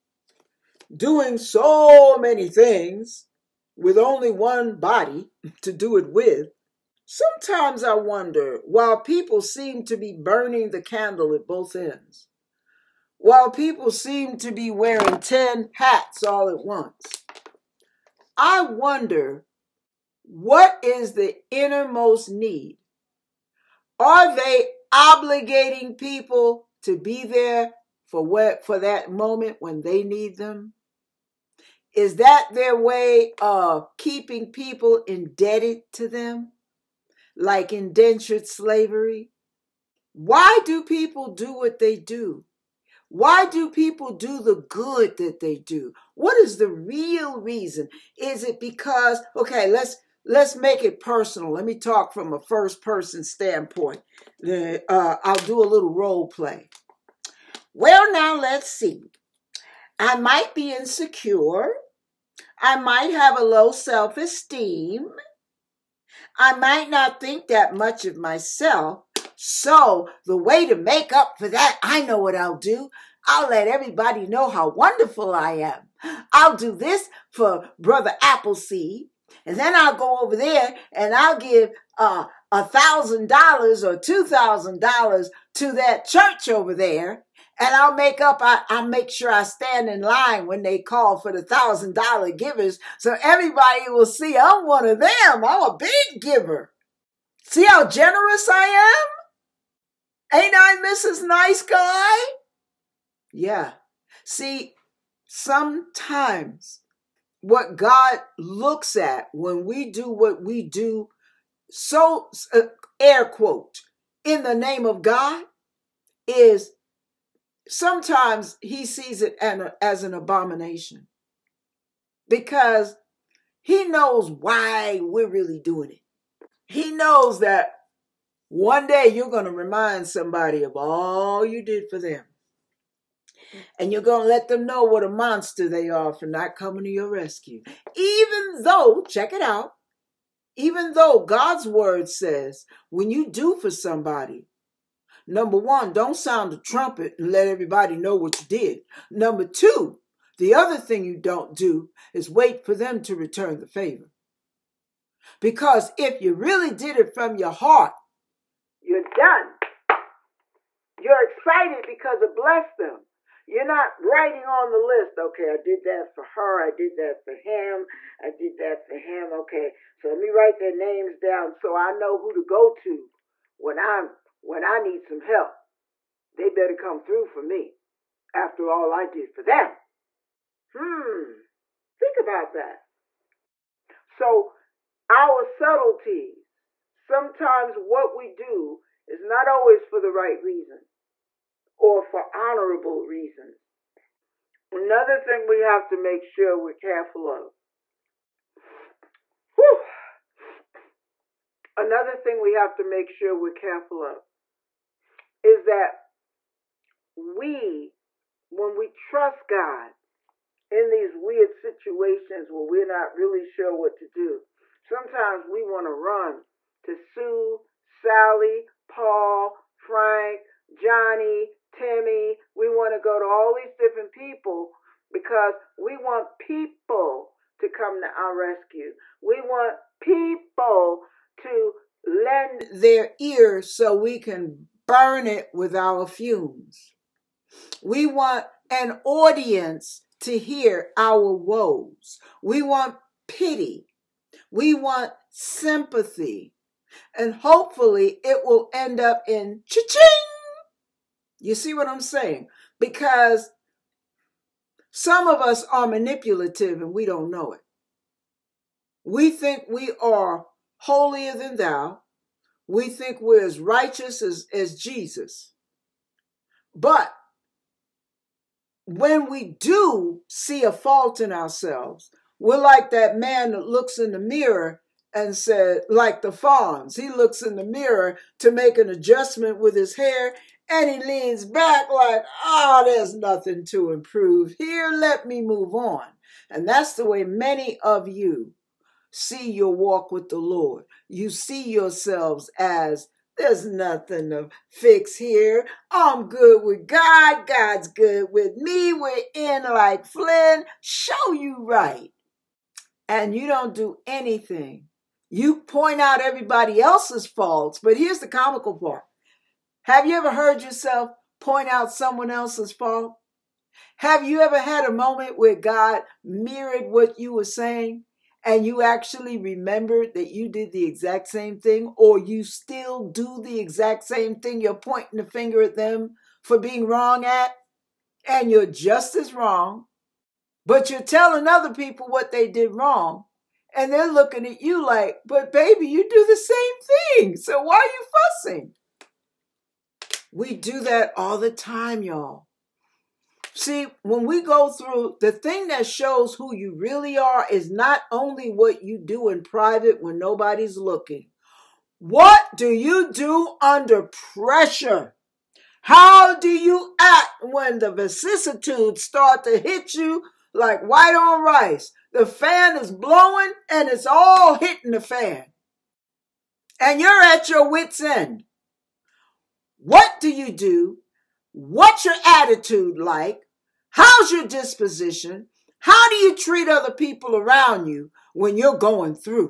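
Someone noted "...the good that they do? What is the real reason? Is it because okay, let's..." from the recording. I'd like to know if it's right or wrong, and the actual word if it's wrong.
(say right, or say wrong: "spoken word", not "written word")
right.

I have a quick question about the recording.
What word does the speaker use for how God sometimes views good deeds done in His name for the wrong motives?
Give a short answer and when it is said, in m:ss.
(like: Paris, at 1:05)
abomination, at 2:00.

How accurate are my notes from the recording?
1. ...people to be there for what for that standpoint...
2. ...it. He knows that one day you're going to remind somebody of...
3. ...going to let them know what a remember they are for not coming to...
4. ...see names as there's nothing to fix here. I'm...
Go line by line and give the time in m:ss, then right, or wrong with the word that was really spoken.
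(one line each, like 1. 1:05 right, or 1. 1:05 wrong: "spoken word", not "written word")
1. 0:25 wrong: "moment", not "standpoint"
2. 2:05 right
3. 2:14 wrong: "monster", not "remember"
4. 4:51 wrong: "yourselves", not "names".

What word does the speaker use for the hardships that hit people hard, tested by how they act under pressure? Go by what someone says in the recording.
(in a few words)
vicissitudes.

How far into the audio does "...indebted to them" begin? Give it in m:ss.
0:35.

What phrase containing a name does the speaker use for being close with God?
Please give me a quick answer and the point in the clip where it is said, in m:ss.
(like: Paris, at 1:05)
in like Flynn, at 4:59.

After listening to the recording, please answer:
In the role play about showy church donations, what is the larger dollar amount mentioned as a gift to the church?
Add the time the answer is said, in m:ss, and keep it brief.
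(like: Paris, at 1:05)
$2,000, at 1:23.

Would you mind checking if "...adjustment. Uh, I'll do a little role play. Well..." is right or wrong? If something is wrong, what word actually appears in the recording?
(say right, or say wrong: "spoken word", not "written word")
wrong: "standpoint", not "adjustment".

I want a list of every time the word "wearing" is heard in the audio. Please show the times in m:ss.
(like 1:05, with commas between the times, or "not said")
0:14.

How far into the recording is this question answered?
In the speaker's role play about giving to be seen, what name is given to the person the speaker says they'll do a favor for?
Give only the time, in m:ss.
1:17.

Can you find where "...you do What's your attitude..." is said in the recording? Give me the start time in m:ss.
6:10.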